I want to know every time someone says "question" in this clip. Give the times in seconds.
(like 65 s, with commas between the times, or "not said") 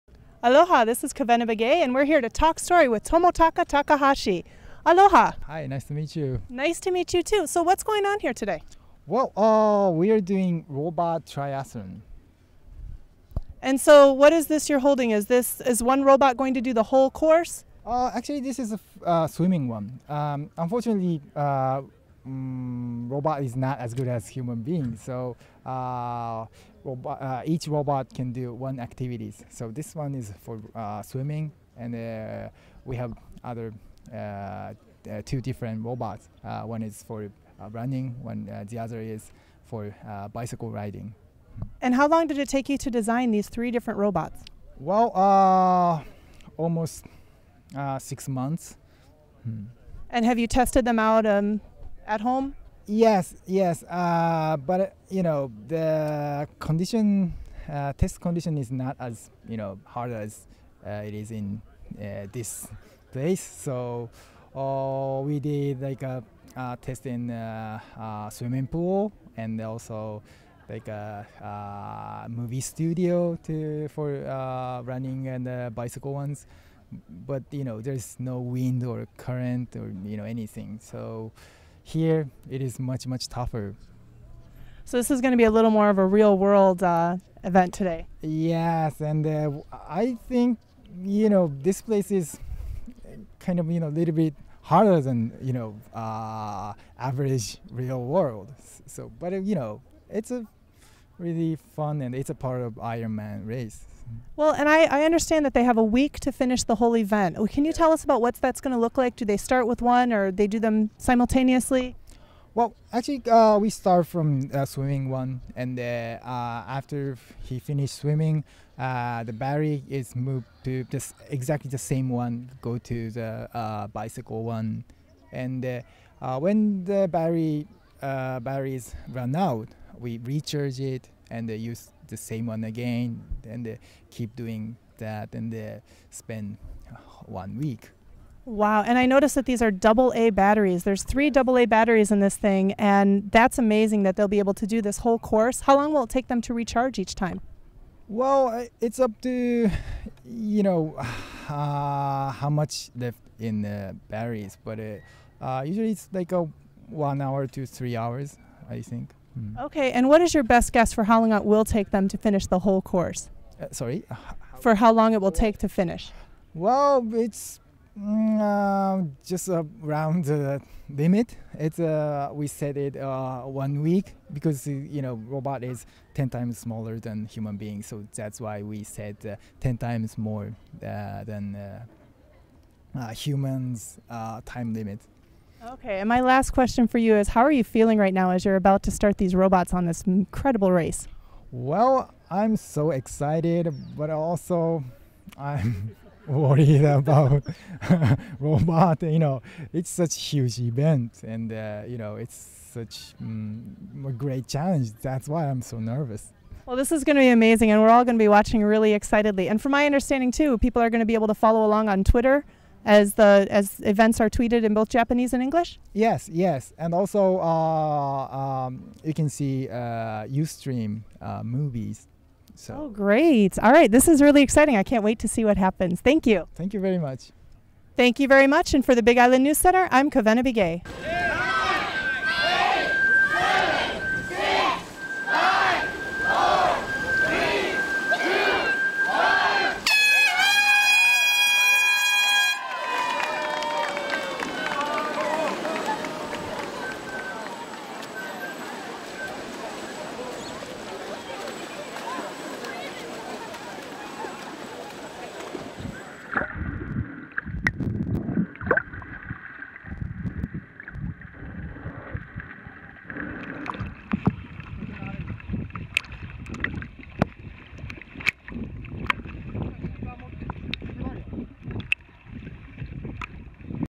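186 s.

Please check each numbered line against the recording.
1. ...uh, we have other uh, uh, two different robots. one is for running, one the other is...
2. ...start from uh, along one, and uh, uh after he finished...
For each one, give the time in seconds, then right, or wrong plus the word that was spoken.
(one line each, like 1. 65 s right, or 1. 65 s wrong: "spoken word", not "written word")
1. 31 s right
2. 113 s wrong: "swimming", not "along".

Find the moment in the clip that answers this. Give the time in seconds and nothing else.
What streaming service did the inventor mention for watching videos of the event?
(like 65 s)
220 s.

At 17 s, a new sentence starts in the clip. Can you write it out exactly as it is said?
Uh, actually, this is a uh, swimming one.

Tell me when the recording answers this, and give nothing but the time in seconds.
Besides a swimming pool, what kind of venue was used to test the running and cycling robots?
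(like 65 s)
72 s.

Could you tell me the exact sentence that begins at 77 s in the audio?
But you know there's no wind or current or you know anything.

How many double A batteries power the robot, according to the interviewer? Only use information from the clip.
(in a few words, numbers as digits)
3.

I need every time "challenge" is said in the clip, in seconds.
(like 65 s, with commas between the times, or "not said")
204 s.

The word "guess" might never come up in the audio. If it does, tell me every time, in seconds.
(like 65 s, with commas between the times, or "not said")
160 s.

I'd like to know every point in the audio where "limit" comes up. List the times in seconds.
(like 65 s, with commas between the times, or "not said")
170 s, 184 s.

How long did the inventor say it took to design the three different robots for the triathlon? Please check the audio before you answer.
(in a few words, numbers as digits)
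almost 6 months.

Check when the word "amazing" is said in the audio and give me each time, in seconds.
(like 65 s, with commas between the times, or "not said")
143 s, 207 s.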